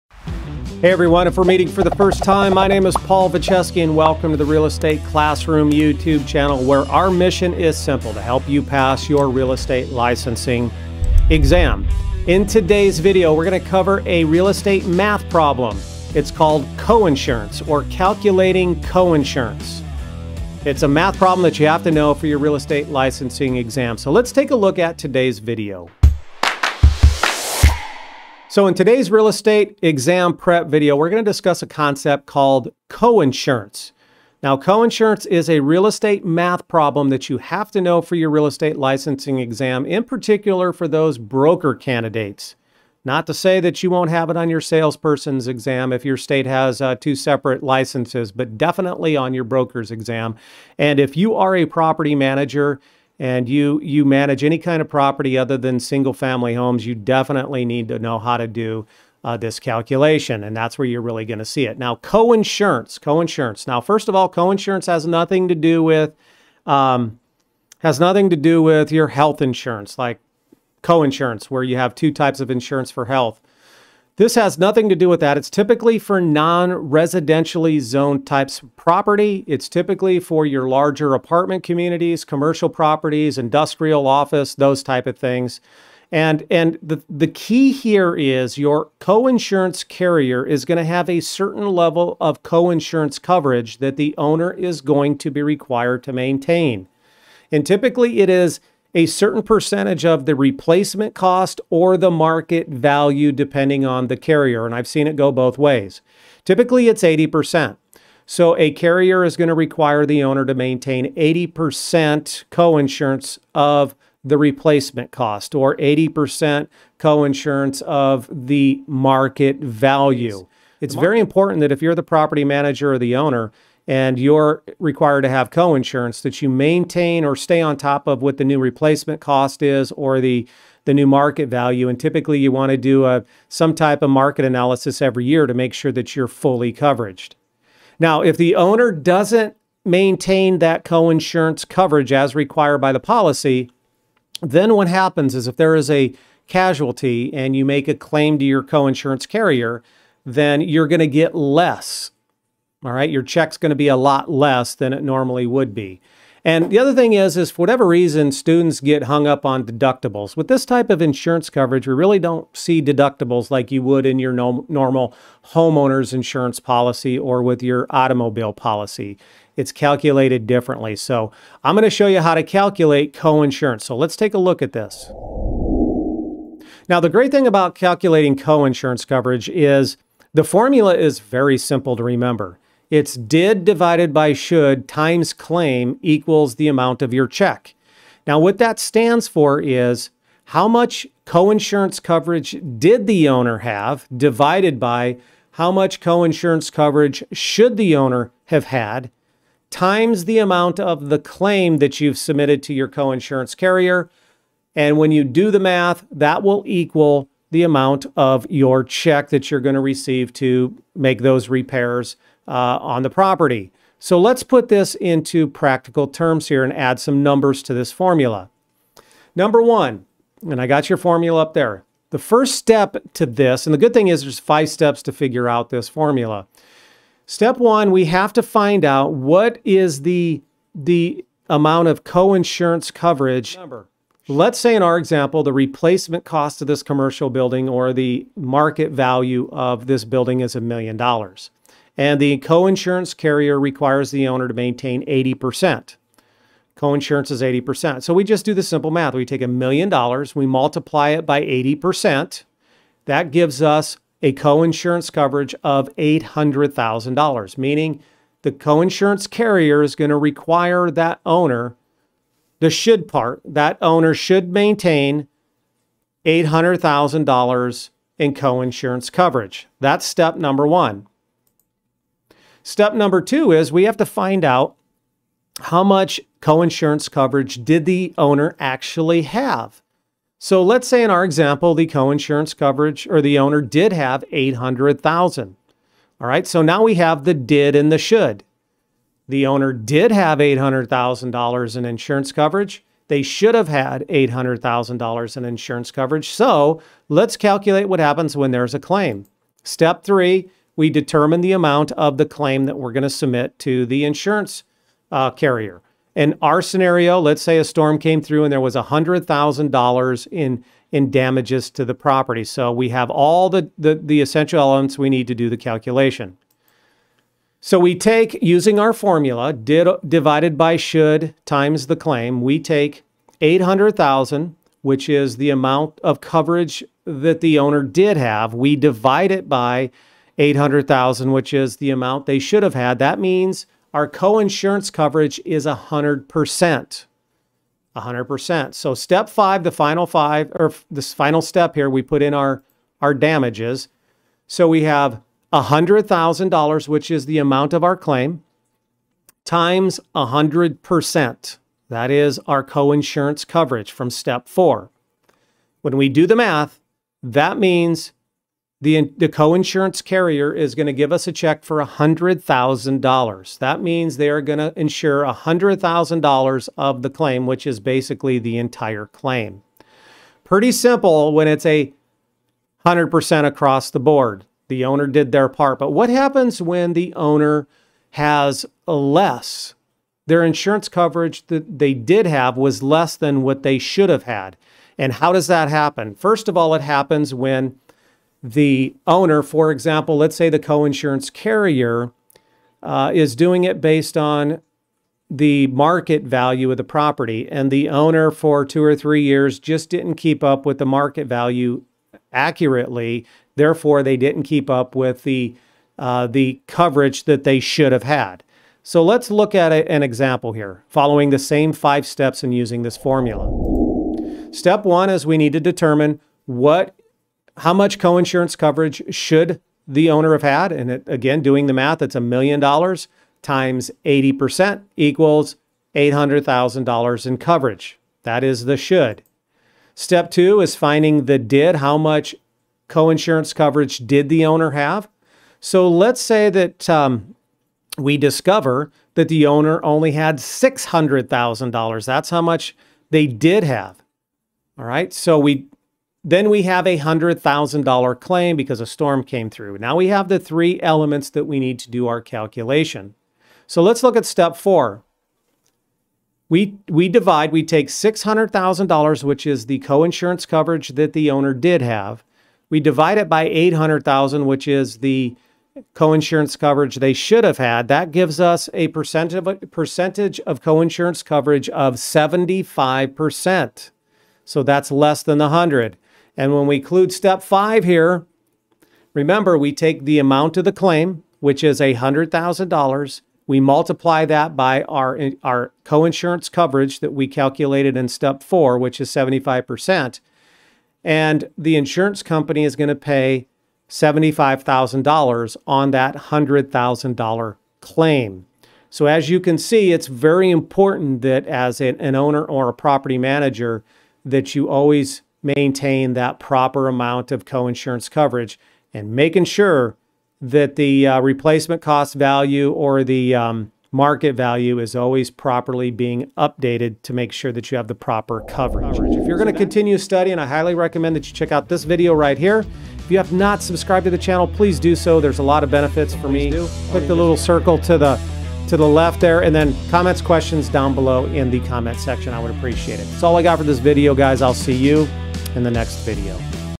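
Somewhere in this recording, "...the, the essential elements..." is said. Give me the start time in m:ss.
5:13.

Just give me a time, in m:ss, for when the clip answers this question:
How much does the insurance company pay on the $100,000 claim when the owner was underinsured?
8:13.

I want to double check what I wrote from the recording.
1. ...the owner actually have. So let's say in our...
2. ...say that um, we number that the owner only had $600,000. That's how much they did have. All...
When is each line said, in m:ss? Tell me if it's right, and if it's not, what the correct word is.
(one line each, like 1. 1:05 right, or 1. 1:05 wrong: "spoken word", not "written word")
1. 4:37 right
2. 7:16 wrong: "discover", not "number".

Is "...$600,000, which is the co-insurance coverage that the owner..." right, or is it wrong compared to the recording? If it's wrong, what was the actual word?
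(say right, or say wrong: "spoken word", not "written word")
right.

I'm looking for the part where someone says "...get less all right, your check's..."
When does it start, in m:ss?
2:31.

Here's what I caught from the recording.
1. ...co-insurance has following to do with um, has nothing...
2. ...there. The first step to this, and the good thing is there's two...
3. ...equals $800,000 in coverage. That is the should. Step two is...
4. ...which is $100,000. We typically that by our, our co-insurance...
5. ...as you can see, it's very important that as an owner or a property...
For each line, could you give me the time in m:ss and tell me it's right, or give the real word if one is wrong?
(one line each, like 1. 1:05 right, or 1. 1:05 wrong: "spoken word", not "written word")
1. 1:04 wrong: "nothing", not "following"
2. 3:41 wrong: "five", not "two"
3. 7:04 right
4. 8:01 wrong: "multiply", not "typically"
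5. 8:19 right.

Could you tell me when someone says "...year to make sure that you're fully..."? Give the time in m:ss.
2:15.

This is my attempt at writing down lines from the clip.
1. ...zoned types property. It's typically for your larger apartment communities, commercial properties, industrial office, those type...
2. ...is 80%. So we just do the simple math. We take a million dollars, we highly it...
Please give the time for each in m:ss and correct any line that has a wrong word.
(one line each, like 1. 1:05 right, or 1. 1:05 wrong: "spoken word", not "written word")
1. 1:17 right
2. 4:07 wrong: "multiply", not "highly".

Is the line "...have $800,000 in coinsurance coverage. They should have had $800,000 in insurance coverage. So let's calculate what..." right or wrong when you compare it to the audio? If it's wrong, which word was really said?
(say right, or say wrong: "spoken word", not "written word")
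wrong: "insurance", not "coinsurance".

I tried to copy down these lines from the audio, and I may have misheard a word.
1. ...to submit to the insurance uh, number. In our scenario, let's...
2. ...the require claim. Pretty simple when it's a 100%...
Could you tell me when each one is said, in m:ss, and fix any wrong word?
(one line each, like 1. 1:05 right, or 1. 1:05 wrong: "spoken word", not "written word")
1. 5:03 wrong: "carrier", not "number"
2. 6:08 wrong: "entire", not "require".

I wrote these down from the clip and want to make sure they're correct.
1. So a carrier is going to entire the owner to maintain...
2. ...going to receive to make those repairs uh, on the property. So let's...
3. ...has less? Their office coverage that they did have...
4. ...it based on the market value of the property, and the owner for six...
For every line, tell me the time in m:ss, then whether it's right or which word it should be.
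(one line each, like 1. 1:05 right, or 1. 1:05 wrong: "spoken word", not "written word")
1. 1:48 wrong: "require", not "entire"
2. 3:29 right
3. 6:18 wrong: "insurance", not "office"
4. 6:33 wrong: "two", not "six".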